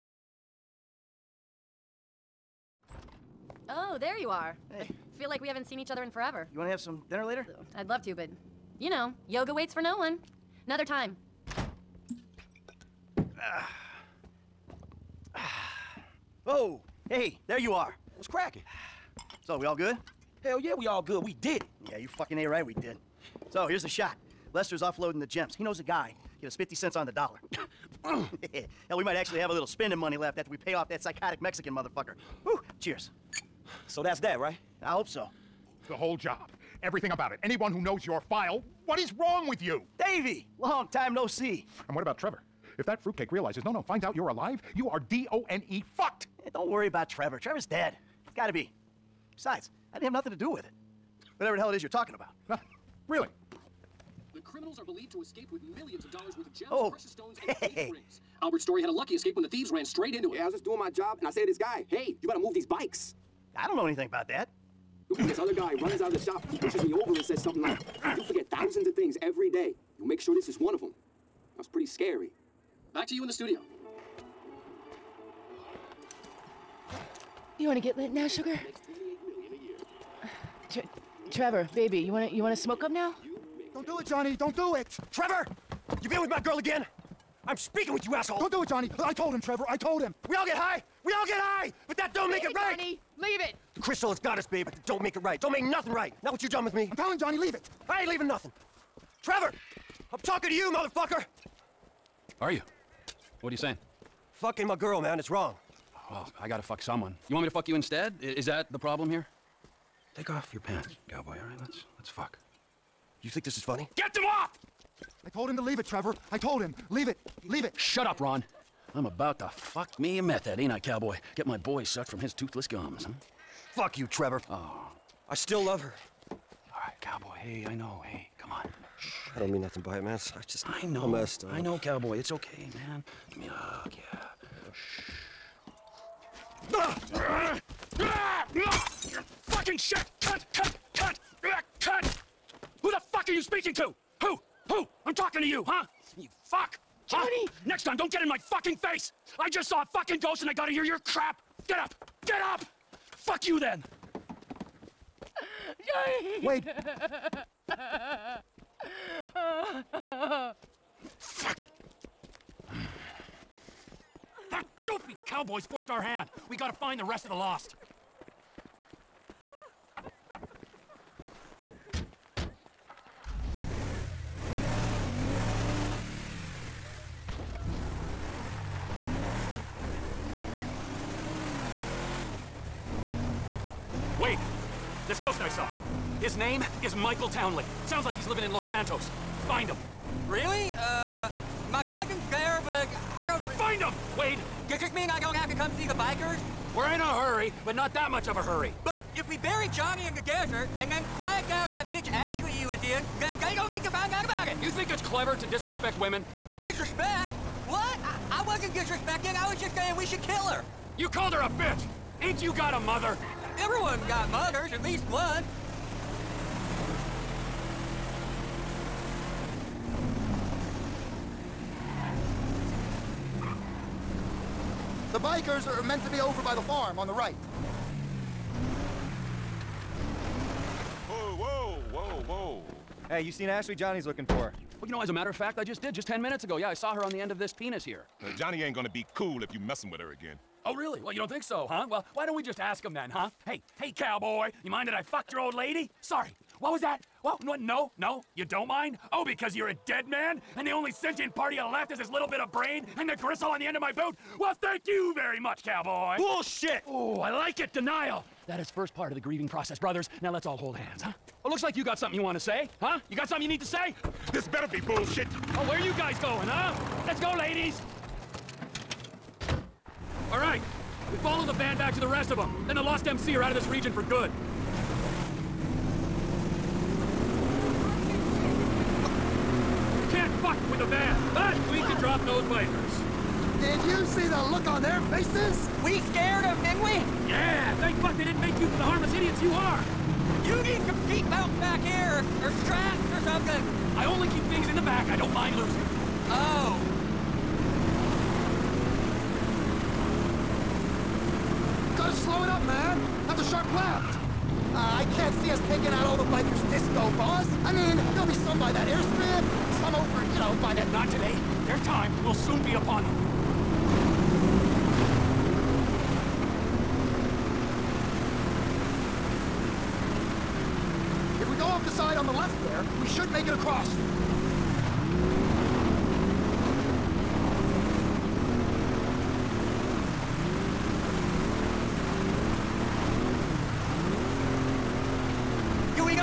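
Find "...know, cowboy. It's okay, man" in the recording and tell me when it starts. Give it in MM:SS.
02:11.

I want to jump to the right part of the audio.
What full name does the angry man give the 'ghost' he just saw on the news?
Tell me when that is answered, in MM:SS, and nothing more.
03:06.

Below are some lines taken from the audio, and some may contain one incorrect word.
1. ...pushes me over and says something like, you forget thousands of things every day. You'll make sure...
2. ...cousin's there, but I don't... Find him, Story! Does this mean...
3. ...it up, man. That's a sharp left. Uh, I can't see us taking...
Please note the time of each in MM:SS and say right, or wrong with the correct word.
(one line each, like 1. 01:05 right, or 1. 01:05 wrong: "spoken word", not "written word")
1. 01:06 right
2. 03:11 wrong: "Wade", not "Story"
3. 05:02 right.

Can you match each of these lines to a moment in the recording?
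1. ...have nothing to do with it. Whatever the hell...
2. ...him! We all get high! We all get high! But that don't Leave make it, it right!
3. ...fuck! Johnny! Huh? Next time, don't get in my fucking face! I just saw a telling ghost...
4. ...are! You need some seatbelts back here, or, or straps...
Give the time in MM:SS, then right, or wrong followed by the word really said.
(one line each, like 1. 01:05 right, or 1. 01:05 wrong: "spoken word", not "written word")
1. 00:50 right
2. 01:30 right
3. 02:26 wrong: "fucking", not "telling"
4. 04:49 right.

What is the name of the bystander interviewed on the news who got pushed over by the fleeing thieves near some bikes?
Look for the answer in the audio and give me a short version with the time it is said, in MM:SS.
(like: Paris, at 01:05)
Albert Story, at 00:58.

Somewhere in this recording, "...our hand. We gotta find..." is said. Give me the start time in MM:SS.
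02:45.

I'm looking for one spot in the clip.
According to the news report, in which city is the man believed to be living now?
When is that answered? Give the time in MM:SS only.
03:08.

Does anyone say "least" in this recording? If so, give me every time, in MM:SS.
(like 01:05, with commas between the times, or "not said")
03:34.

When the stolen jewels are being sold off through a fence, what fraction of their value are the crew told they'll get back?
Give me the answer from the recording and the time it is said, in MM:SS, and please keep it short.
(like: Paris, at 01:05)
50 cents on the dollar, at 00:26.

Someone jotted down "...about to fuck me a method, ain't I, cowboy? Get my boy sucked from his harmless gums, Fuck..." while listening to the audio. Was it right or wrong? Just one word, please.
wrong.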